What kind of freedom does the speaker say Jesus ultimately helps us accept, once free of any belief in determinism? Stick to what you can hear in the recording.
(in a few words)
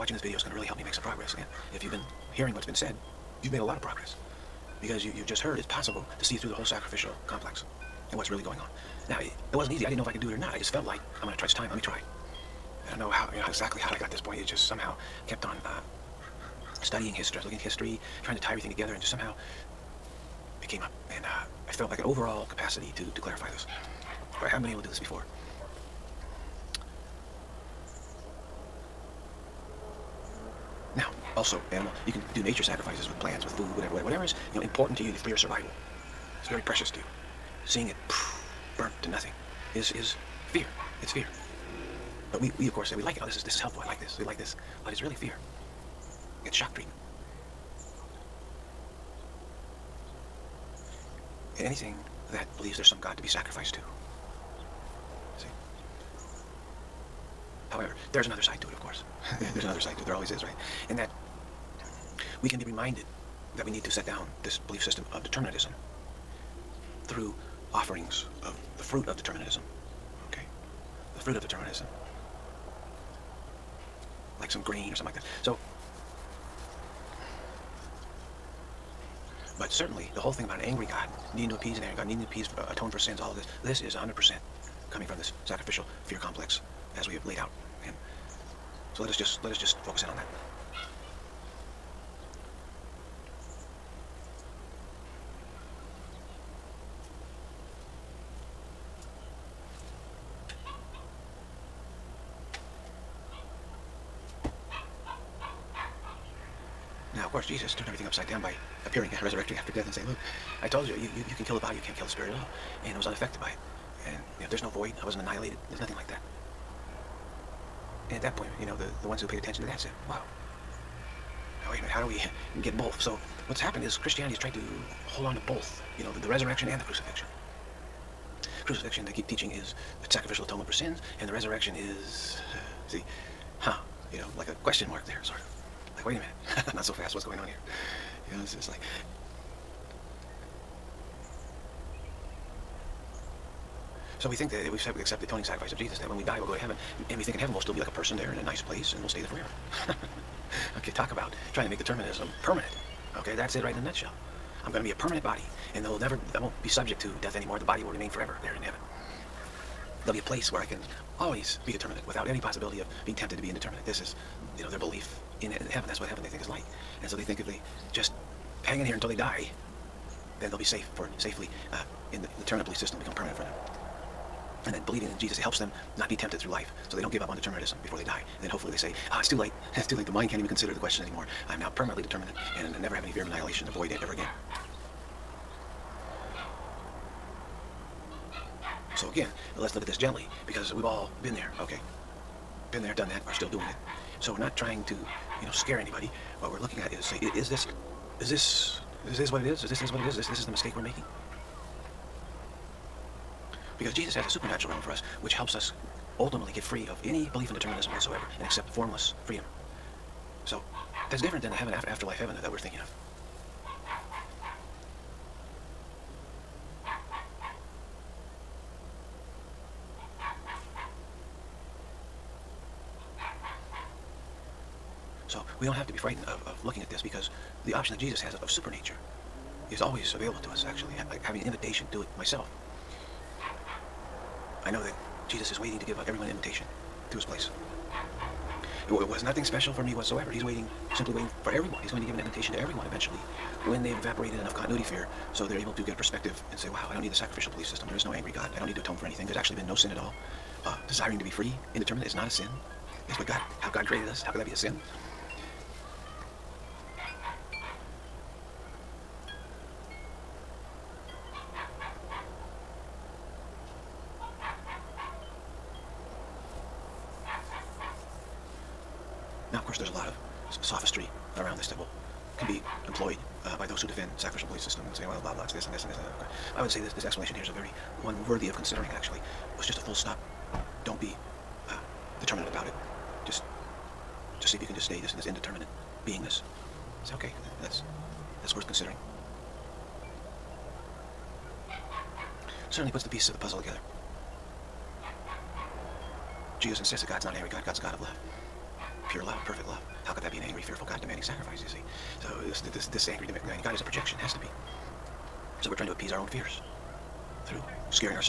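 Formless freedom.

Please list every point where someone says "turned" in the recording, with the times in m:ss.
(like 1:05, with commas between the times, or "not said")
1:47.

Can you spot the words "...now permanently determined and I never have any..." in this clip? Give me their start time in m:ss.
3:01.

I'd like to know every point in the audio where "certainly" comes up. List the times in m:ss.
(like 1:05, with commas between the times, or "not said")
1:19, 4:52.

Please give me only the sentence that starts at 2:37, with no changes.
The body will remain forever there in heaven.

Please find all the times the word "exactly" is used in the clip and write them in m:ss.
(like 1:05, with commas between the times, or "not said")
0:13.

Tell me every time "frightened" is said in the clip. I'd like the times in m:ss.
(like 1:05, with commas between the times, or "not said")
3:45.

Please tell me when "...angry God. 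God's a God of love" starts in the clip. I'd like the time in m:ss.
4:57.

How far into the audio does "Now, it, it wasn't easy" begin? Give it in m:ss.
0:09.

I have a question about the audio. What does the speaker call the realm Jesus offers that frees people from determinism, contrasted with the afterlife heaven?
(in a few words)
Supernatural realm.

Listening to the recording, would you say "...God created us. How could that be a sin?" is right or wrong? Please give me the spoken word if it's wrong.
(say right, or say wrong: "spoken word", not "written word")
right.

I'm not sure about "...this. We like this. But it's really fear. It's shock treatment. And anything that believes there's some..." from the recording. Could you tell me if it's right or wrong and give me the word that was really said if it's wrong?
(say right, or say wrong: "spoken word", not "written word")
right.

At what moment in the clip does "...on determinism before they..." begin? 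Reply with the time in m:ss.
2:57.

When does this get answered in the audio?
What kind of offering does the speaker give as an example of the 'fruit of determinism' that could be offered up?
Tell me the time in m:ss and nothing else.
1:14.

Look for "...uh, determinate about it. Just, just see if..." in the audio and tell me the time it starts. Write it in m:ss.
4:41.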